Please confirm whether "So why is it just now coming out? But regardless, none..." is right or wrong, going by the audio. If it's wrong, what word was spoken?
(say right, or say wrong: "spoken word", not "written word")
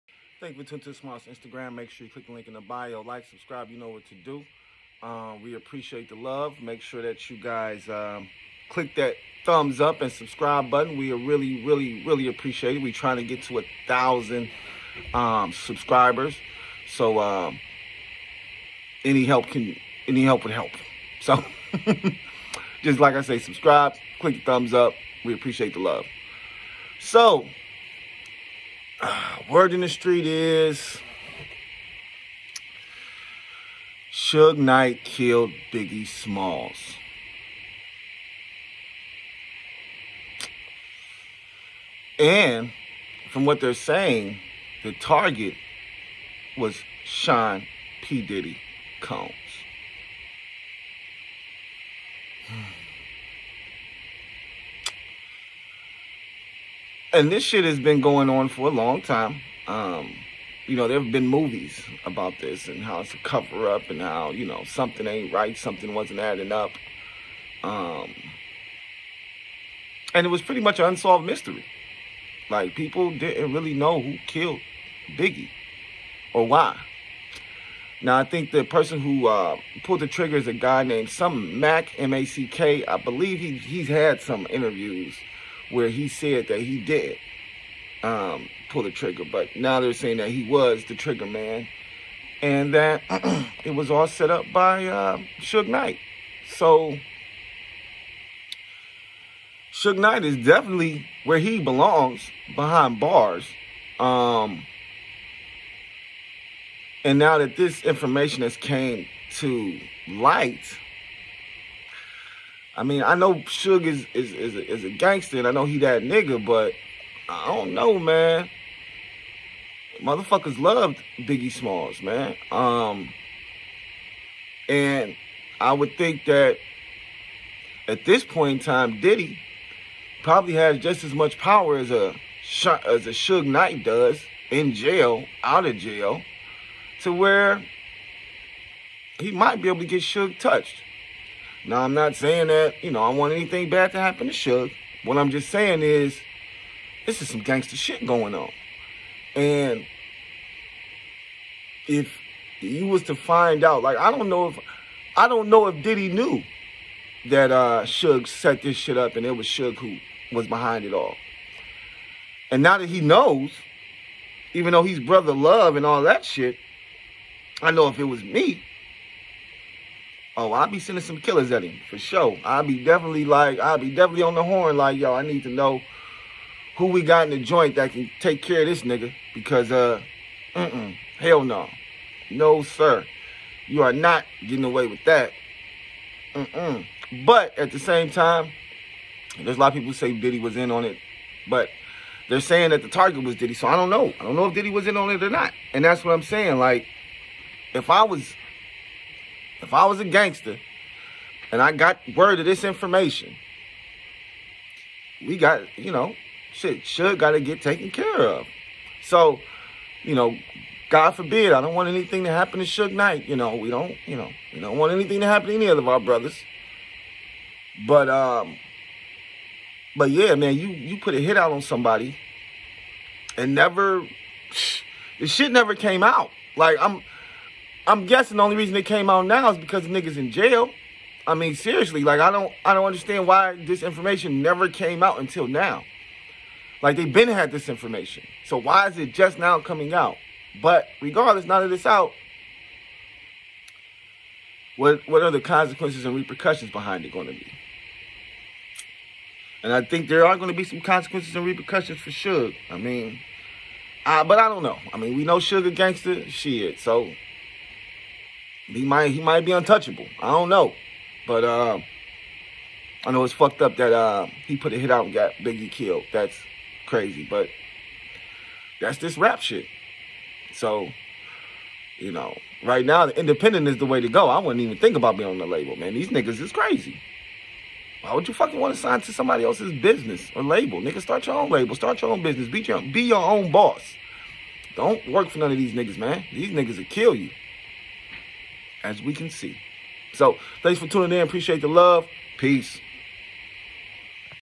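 right.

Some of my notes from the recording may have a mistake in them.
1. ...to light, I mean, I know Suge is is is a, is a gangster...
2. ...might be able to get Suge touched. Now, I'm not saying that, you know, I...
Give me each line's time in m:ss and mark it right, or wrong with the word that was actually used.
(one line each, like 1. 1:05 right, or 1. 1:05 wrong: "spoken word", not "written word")
1. 1:49 right
2. 2:19 right.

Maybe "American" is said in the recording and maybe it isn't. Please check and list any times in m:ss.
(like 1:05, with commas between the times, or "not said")
not said.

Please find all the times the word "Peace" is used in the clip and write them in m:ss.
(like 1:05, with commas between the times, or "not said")
4:52.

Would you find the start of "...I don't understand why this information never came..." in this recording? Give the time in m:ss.
3:52.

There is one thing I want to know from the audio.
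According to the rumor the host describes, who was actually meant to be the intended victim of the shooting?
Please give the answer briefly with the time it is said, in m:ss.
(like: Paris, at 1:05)
Sean P. Diddy Combs, at 0:47.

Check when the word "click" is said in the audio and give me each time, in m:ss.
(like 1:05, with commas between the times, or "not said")
0:02, 0:08, 0:24.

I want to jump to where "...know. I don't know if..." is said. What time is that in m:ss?
3:13.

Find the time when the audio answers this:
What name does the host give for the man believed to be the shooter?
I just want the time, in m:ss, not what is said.
1:21.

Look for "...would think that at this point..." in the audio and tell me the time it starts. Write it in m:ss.
2:05.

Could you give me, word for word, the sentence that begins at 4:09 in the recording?
And I think there are going to be some consequences and repercussions for Suge.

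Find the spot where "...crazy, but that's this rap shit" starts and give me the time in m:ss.
4:26.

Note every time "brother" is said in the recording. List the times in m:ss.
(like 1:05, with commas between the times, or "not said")
2:44, 3:35.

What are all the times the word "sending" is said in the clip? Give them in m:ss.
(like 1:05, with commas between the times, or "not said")
2:50.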